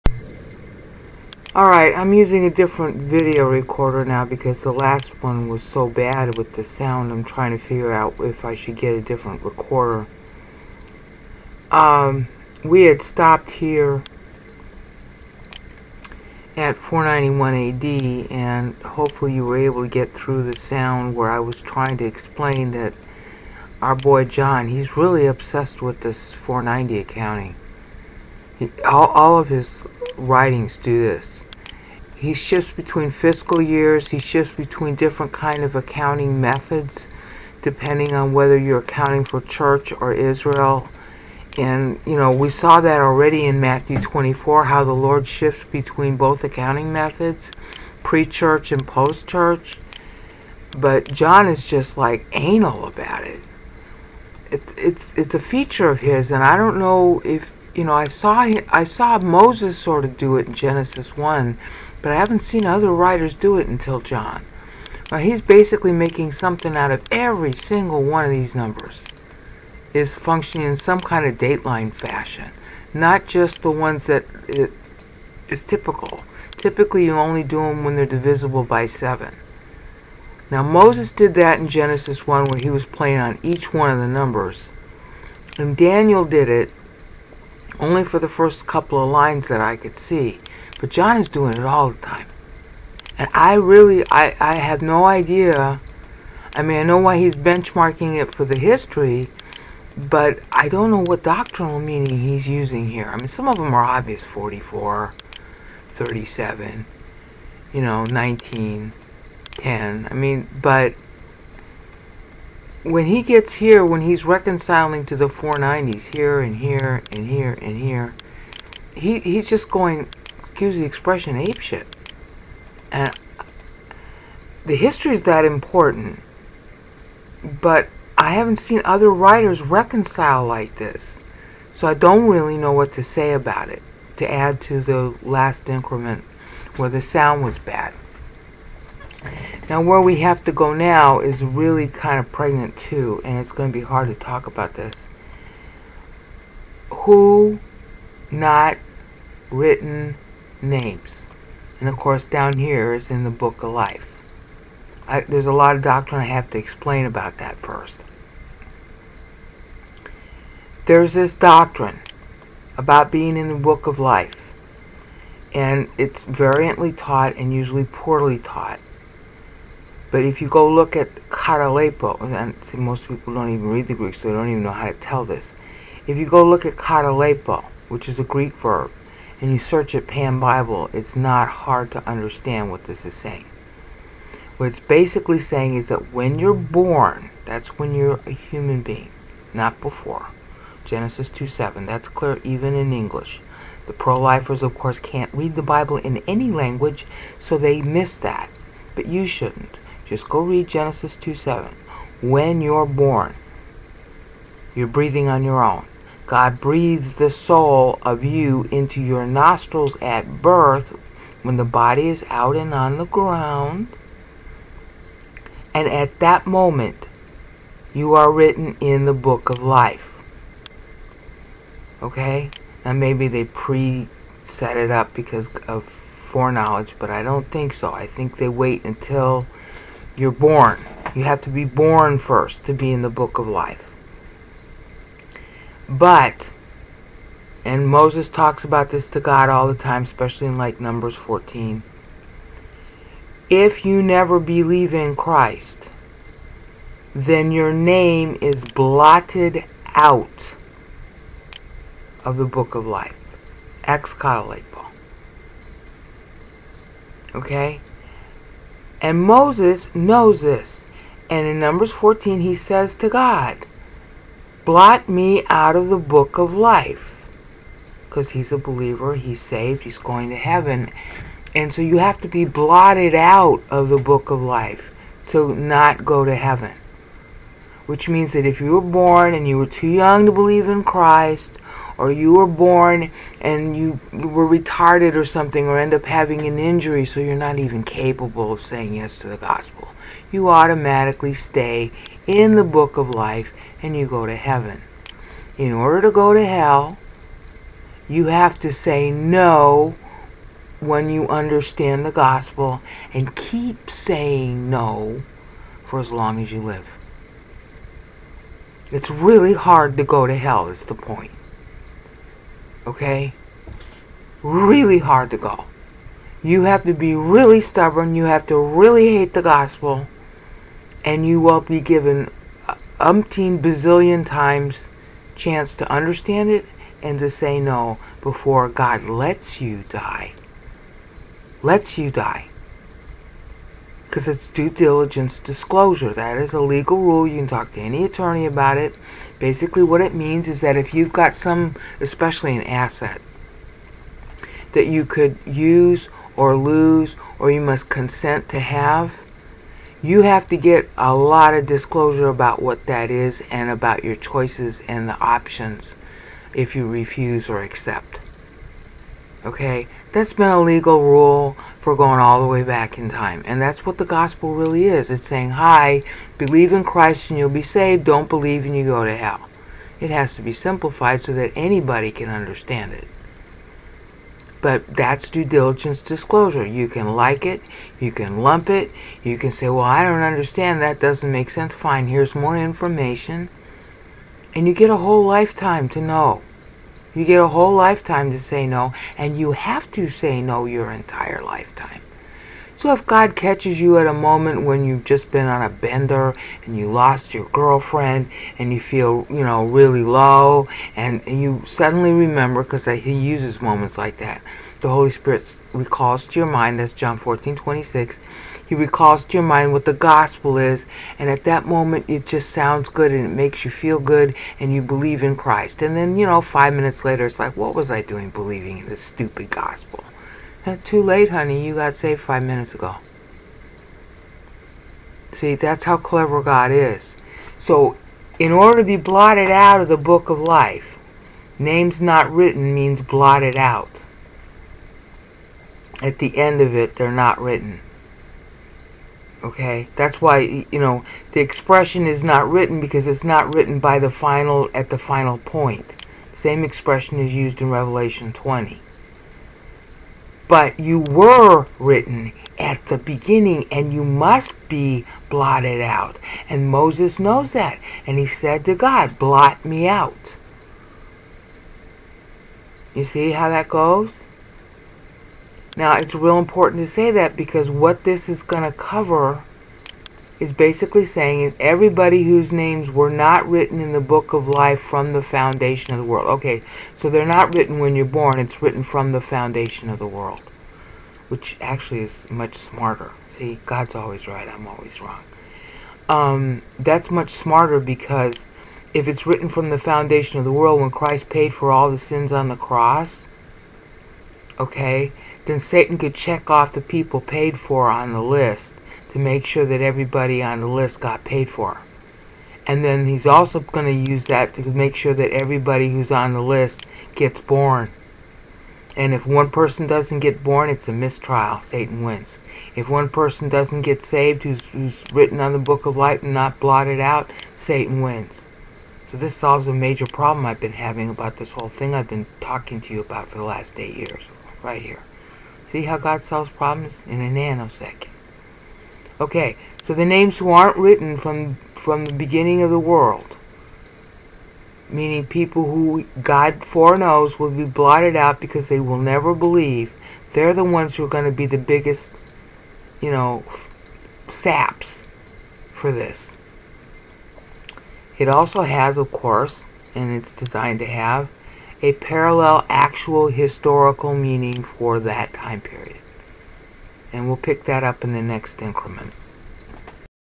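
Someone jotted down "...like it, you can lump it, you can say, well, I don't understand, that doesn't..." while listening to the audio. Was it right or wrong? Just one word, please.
right.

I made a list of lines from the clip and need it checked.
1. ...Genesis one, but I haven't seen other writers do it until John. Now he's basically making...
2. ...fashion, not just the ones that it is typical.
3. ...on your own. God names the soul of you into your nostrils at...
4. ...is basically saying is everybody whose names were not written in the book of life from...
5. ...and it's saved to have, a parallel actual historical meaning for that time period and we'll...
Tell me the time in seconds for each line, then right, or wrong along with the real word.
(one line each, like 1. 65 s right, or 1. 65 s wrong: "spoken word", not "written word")
1. 60 s right
2. 71 s right
3. 205 s wrong: "breathes", not "names"
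4. 470 s right
5. 549 s wrong: "designed", not "saved".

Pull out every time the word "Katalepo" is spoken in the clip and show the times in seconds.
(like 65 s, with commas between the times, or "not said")
171 s, 176 s.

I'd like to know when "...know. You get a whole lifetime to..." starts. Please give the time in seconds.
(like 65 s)
386 s.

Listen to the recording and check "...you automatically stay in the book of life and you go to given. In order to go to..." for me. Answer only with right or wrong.
wrong.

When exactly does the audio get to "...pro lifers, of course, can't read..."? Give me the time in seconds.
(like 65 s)
193 s.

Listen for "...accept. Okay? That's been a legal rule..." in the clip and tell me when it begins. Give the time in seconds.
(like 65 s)
357 s.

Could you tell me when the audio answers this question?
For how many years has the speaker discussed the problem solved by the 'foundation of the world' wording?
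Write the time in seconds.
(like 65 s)
523 s.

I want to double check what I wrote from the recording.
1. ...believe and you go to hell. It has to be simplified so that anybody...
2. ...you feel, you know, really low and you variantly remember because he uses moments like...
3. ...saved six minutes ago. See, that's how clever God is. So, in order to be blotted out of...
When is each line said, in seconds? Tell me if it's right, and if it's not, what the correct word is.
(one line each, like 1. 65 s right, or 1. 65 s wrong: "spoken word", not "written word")
1. 368 s right
2. 398 s wrong: "suddenly", not "variantly"
3. 421 s wrong: "five", not "six".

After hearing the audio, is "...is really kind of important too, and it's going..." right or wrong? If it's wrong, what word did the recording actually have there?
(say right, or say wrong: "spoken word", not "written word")
wrong: "pregnant", not "important".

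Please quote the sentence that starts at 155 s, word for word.
I, there's a lot of doctrine I have to explain about that first.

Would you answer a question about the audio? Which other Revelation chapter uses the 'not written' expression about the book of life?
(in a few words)
Revelation 20.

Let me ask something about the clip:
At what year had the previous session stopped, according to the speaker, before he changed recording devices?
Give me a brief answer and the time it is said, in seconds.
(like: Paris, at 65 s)
491 AD, at 16 s.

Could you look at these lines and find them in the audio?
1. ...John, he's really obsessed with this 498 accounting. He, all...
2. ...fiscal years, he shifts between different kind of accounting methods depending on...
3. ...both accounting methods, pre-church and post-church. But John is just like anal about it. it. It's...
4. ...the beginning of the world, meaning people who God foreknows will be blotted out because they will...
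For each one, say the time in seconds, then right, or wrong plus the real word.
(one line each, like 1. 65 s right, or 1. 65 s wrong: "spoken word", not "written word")
1. 24 s wrong: "490", not "498"
2. 33 s right
3. 46 s right
4. 532 s right.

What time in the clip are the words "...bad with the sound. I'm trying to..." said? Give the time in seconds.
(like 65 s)
5 s.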